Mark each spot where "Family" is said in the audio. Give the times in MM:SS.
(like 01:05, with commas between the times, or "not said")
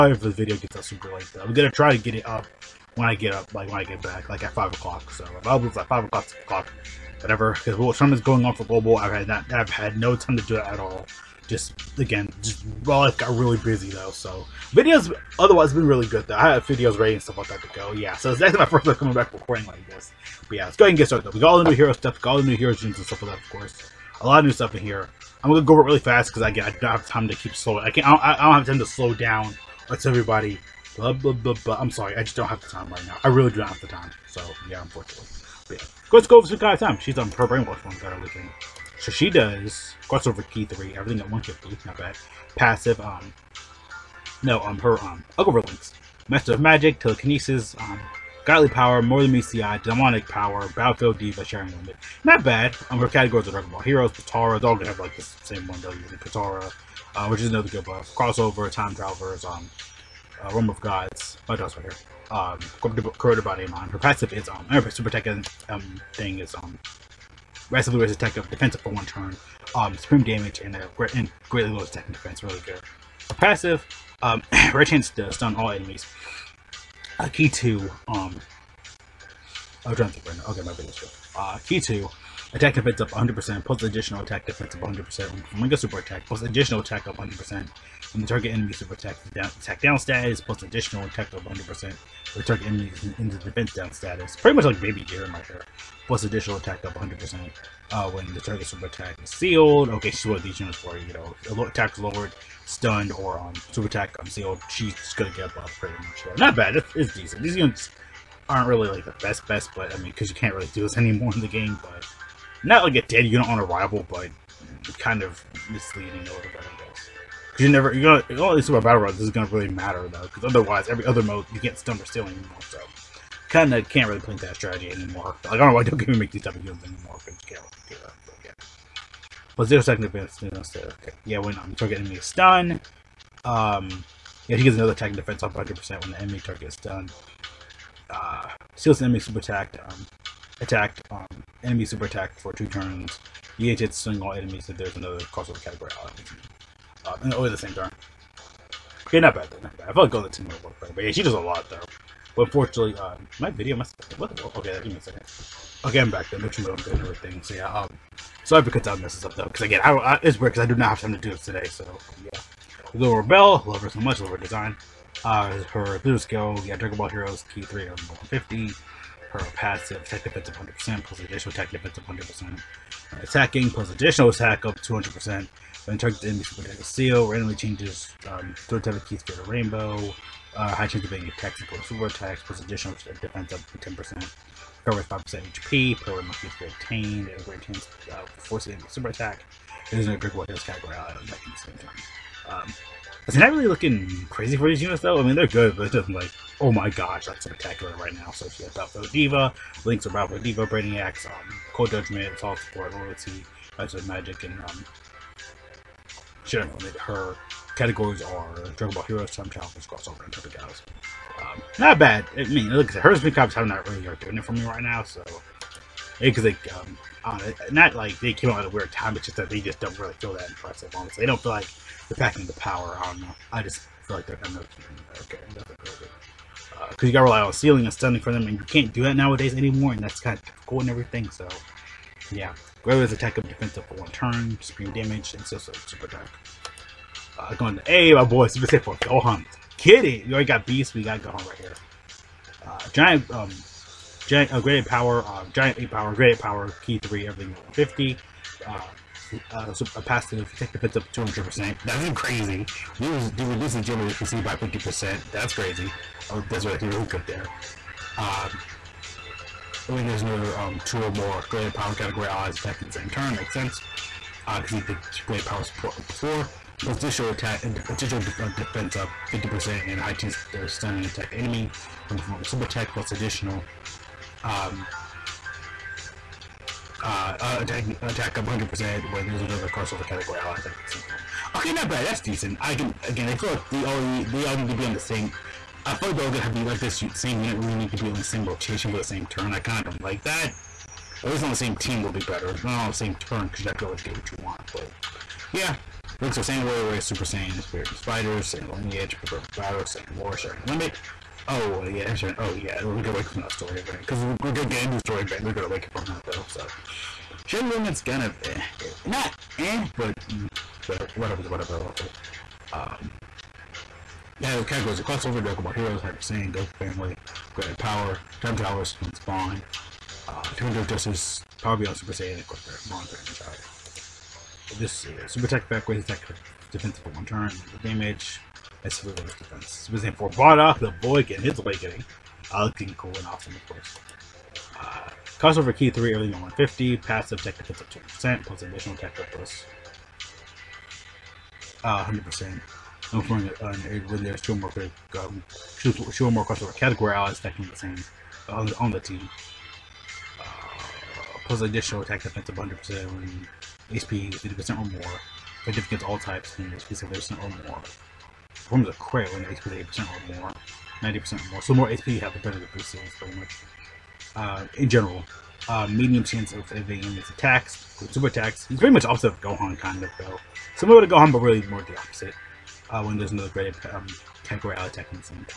05:16.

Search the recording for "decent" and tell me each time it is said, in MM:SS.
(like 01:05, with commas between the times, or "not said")
01:47, 04:42.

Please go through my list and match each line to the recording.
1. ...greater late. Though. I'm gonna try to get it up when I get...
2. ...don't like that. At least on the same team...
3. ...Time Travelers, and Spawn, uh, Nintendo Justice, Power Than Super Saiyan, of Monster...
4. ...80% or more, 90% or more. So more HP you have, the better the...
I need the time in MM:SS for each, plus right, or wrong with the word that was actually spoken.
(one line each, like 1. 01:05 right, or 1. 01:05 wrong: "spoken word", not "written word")
1. 00:00 wrong: "super", not "greater"
2. 04:49 right
3. 05:18 wrong: "Beyond", not "Than"
4. 05:59 right.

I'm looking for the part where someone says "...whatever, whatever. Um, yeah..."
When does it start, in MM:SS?
05:11.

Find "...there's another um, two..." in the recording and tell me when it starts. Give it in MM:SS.
04:20.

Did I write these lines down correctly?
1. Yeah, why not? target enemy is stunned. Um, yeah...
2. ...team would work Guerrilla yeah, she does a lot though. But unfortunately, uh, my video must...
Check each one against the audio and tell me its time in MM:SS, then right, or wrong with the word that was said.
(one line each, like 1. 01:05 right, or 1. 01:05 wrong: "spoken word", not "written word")
1. 02:11 right
2. 02:30 wrong: "But", not "Guerrilla".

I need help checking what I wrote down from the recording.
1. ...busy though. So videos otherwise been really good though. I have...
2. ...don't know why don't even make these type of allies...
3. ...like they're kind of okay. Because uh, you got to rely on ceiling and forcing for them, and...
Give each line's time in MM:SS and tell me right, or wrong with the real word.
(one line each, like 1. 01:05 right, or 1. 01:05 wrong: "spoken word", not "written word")
1. 00:13 right
2. 02:05 wrong: "games", not "allies"
3. 03:44 wrong: "stunning", not "forcing".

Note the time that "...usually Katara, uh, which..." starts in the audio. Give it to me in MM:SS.
00:55.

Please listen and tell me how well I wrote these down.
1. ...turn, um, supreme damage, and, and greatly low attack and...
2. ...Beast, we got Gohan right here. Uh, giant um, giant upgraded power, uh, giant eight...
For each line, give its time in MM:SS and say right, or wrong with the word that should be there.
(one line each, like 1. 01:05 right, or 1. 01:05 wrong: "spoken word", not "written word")
1. 01:09 right
2. 04:00 right.